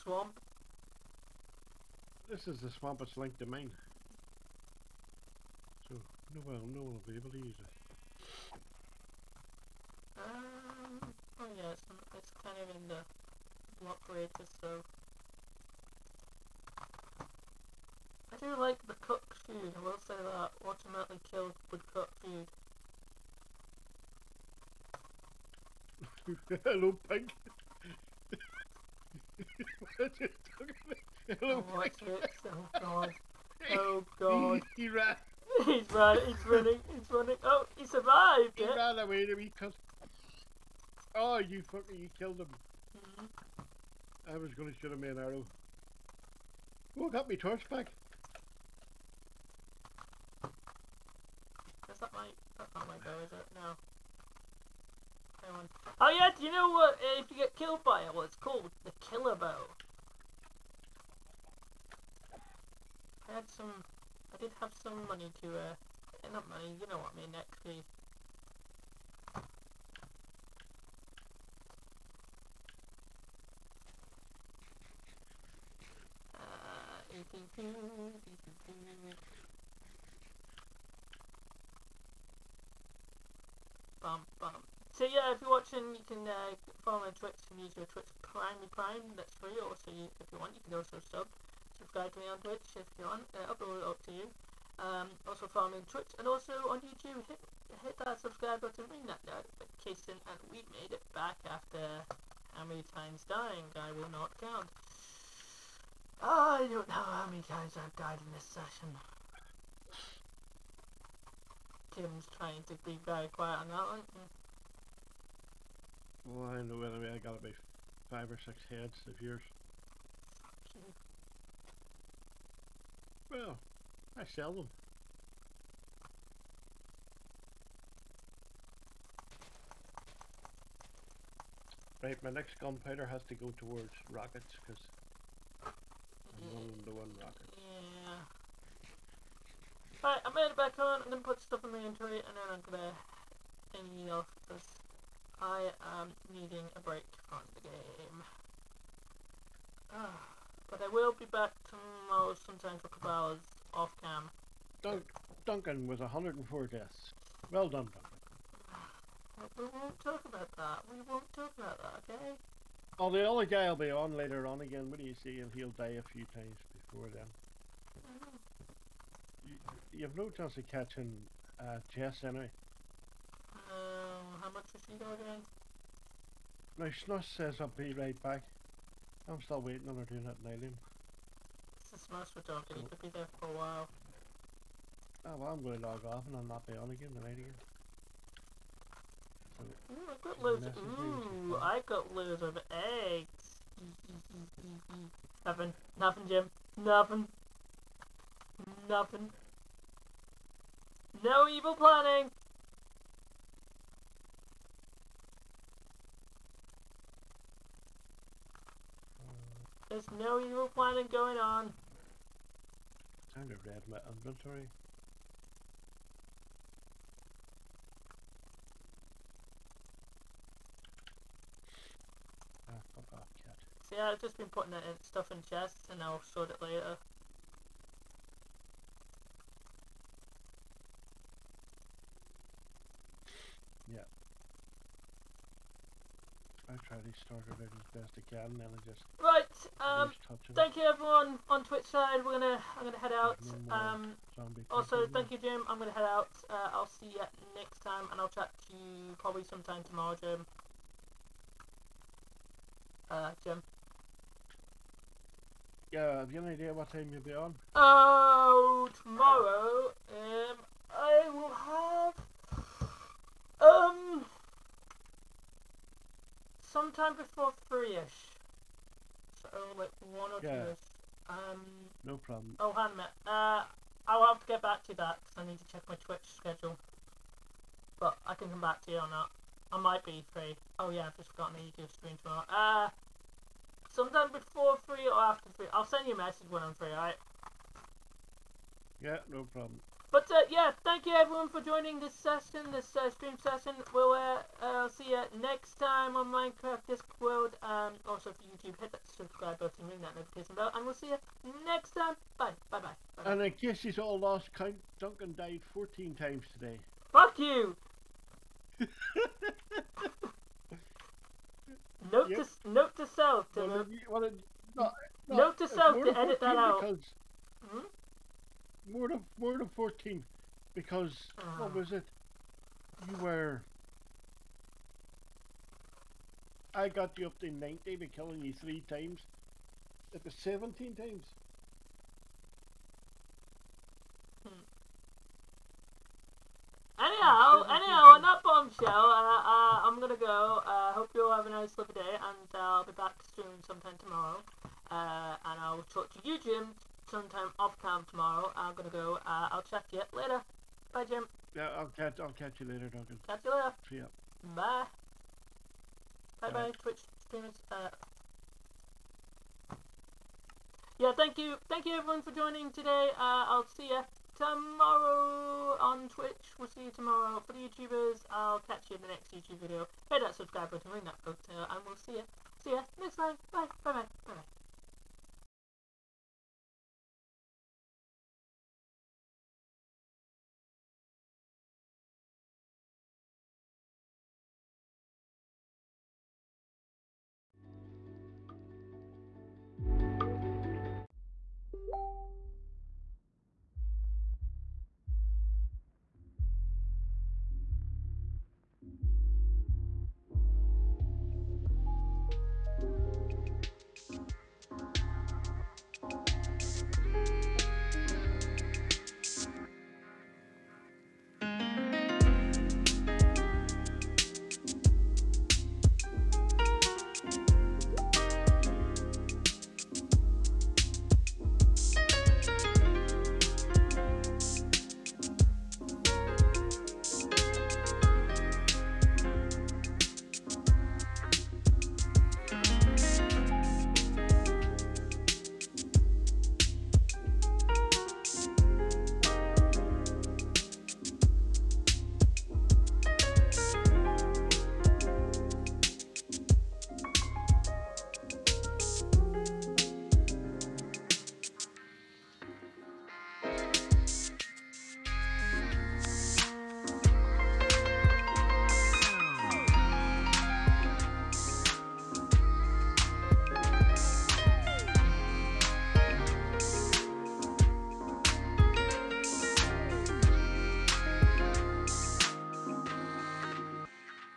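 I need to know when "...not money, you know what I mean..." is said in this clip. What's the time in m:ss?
1:06.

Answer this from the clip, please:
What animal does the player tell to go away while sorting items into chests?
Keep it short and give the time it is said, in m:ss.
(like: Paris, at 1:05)
cat, at 3:43.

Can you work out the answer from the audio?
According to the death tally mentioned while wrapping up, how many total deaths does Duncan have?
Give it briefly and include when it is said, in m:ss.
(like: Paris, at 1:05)
104, at 2:35.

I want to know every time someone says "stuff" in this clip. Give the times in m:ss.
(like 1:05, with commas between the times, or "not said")
2:21, 3:45.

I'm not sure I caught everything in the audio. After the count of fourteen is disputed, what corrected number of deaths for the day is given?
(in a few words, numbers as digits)
17.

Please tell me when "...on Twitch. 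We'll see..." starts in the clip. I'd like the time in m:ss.
6:05.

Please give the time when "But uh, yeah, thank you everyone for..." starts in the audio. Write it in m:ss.
4:50.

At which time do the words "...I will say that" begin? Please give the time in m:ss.
0:19.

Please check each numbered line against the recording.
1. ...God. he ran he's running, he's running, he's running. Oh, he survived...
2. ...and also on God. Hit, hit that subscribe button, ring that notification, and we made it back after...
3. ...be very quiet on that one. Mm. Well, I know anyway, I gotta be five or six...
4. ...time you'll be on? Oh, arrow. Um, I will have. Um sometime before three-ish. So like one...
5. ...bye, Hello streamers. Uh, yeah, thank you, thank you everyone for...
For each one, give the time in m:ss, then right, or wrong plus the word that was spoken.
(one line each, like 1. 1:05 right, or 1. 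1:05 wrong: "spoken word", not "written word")
1. 0:34 right
2. 1:36 wrong: "YouTube", not "God"
3. 1:52 right
4. 4:16 wrong: "tomorrow", not "arrow"
5. 5:56 wrong: "Twitch", not "Hello".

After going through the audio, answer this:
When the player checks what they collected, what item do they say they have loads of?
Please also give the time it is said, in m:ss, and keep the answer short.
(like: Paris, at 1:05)
eggs, at 3:13.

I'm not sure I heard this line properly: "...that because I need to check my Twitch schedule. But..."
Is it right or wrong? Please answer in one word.
right.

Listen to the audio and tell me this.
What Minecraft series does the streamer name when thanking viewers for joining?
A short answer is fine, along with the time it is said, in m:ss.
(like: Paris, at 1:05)
Minecraft Discworld, at 4:56.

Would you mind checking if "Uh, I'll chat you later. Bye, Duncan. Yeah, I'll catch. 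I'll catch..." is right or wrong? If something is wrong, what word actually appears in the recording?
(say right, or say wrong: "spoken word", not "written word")
wrong: "Jim", not "Duncan".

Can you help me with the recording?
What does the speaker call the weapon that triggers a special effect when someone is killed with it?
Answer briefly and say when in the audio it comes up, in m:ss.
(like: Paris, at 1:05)
killer bow, at 0:59.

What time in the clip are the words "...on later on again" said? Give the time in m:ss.
2:43.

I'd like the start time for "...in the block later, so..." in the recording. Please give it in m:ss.
0:12.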